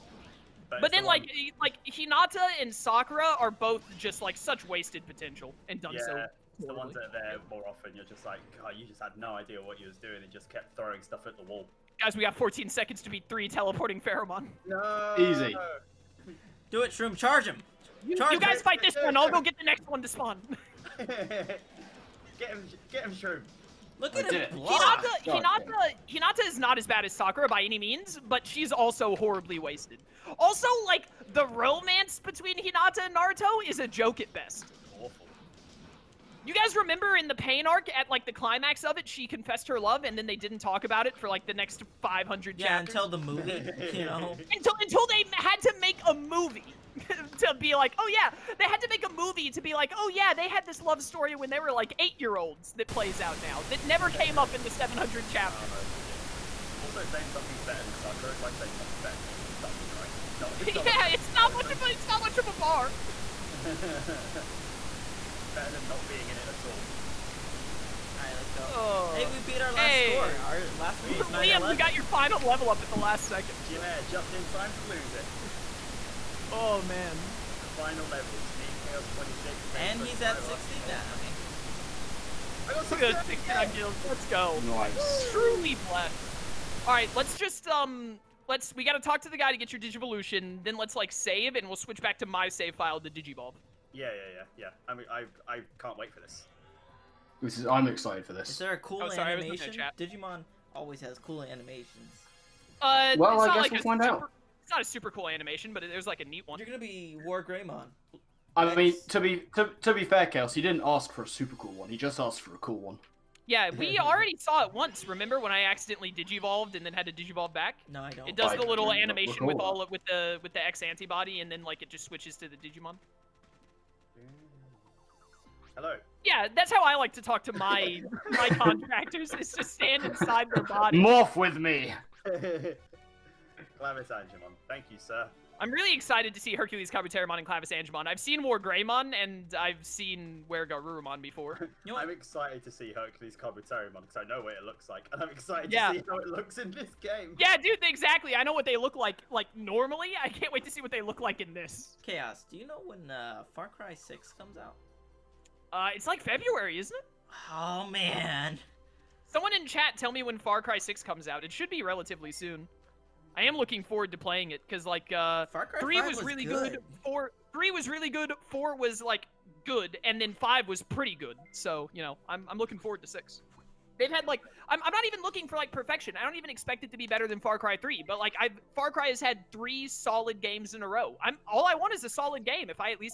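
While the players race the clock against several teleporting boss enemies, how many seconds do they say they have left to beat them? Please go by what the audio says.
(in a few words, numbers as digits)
14.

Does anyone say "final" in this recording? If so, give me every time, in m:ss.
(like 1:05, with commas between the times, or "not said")
1:12, 1:17.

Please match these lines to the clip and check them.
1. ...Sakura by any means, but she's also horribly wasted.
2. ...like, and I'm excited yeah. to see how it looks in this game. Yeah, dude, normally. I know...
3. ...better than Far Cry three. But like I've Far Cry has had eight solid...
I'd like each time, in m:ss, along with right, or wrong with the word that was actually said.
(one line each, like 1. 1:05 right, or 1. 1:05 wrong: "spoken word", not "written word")
1. 0:27 right
2. 2:24 wrong: "exactly", not "normally"
3. 2:57 wrong: "three", not "eight".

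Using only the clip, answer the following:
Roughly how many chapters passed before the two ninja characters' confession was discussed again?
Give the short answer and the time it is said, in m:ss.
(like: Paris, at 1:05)
500, at 0:42.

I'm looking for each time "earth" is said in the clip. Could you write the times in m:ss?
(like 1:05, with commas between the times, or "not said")
not said.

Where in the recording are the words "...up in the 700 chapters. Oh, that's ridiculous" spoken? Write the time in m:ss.
0:54.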